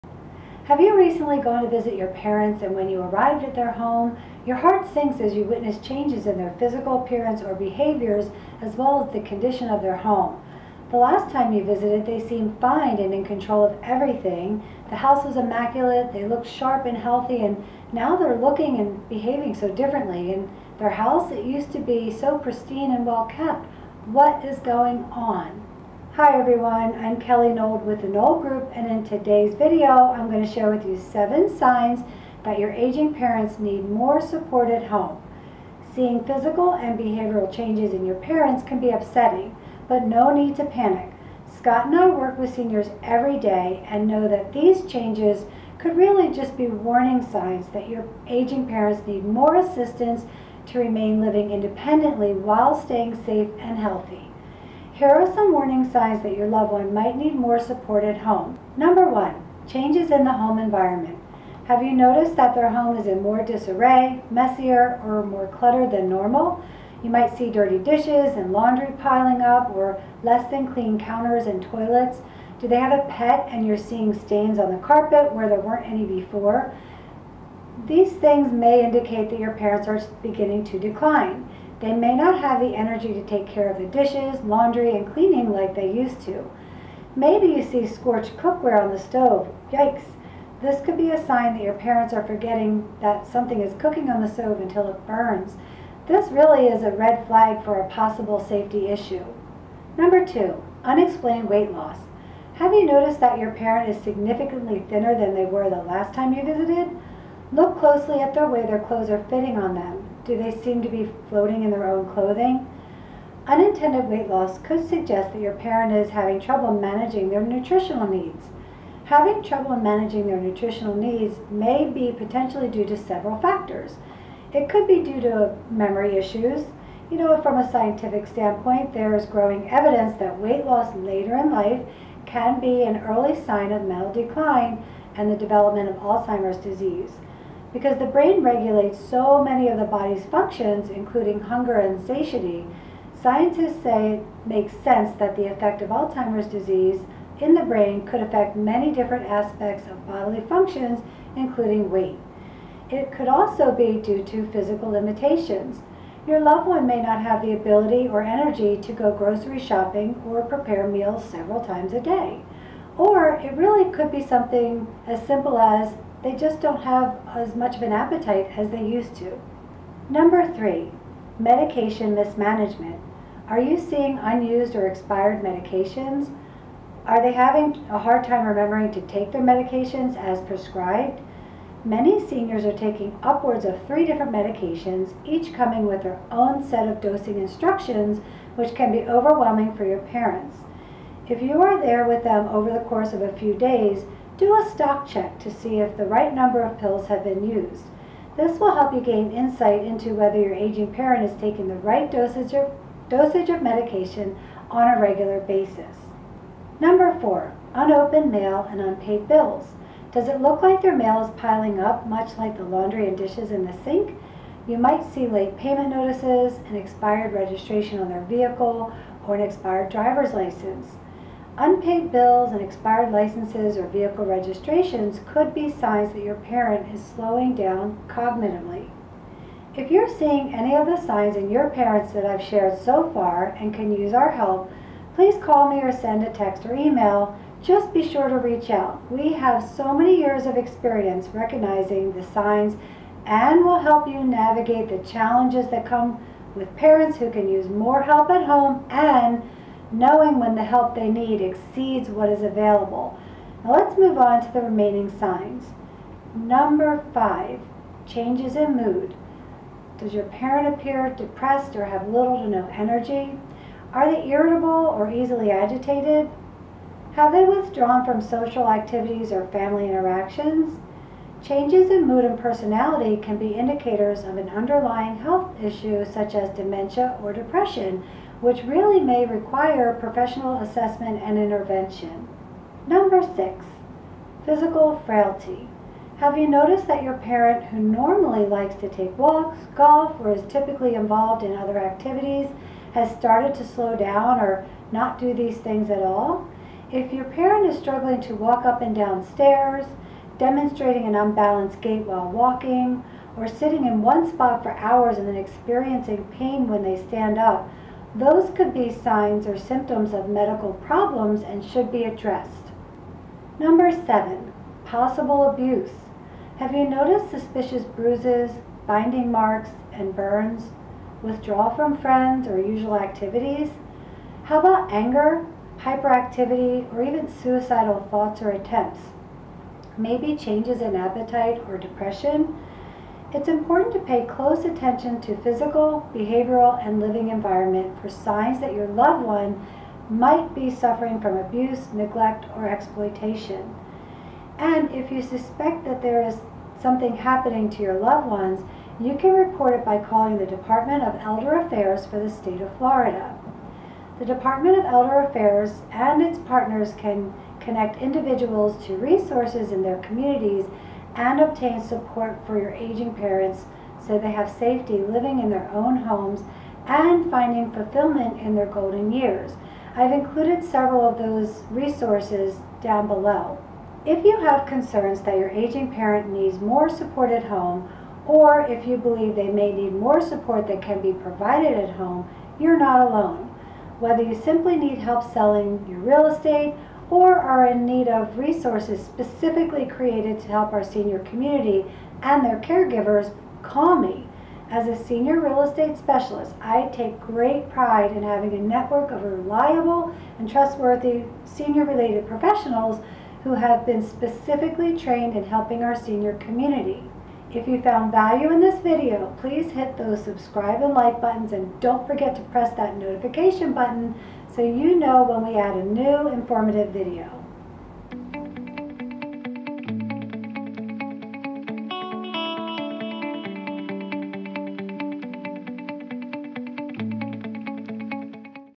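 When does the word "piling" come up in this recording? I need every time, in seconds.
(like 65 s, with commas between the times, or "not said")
69 s, 211 s.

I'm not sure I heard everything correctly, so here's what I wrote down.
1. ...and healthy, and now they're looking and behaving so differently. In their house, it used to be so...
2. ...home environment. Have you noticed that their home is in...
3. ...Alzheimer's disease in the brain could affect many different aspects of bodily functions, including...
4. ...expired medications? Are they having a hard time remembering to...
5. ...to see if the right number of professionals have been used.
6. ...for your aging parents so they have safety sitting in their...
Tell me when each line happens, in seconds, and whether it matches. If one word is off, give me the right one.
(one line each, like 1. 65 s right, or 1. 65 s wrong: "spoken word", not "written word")
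1. 16 s right
2. 60 s right
3. 145 s right
4. 174 s right
5. 195 s wrong: "pills", not "professionals"
6. 362 s wrong: "living", not "sitting".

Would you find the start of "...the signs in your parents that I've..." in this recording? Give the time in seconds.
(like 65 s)
230 s.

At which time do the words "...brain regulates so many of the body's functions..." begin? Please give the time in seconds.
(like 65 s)
138 s.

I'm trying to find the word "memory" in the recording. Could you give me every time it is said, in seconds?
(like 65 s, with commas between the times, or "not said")
125 s.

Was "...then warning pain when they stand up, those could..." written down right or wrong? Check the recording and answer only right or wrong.
wrong.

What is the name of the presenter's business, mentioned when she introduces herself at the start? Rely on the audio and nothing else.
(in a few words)
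The Nold Group.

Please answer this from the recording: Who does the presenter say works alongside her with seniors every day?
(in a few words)
Scott.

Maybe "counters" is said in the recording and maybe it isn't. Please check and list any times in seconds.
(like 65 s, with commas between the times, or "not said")
70 s.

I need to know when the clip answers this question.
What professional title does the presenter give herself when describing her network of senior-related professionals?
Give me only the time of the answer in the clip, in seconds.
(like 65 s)
395 s.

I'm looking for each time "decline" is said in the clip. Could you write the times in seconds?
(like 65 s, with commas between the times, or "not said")
80 s, 134 s.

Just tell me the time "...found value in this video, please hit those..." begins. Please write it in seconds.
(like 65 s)
407 s.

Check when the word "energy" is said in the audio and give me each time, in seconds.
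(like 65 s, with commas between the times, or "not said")
82 s, 158 s, 262 s.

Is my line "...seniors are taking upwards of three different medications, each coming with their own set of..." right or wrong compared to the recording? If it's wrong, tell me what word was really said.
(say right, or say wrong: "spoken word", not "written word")
right.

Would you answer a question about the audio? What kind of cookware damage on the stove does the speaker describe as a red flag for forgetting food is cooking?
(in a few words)
Scorched cookware.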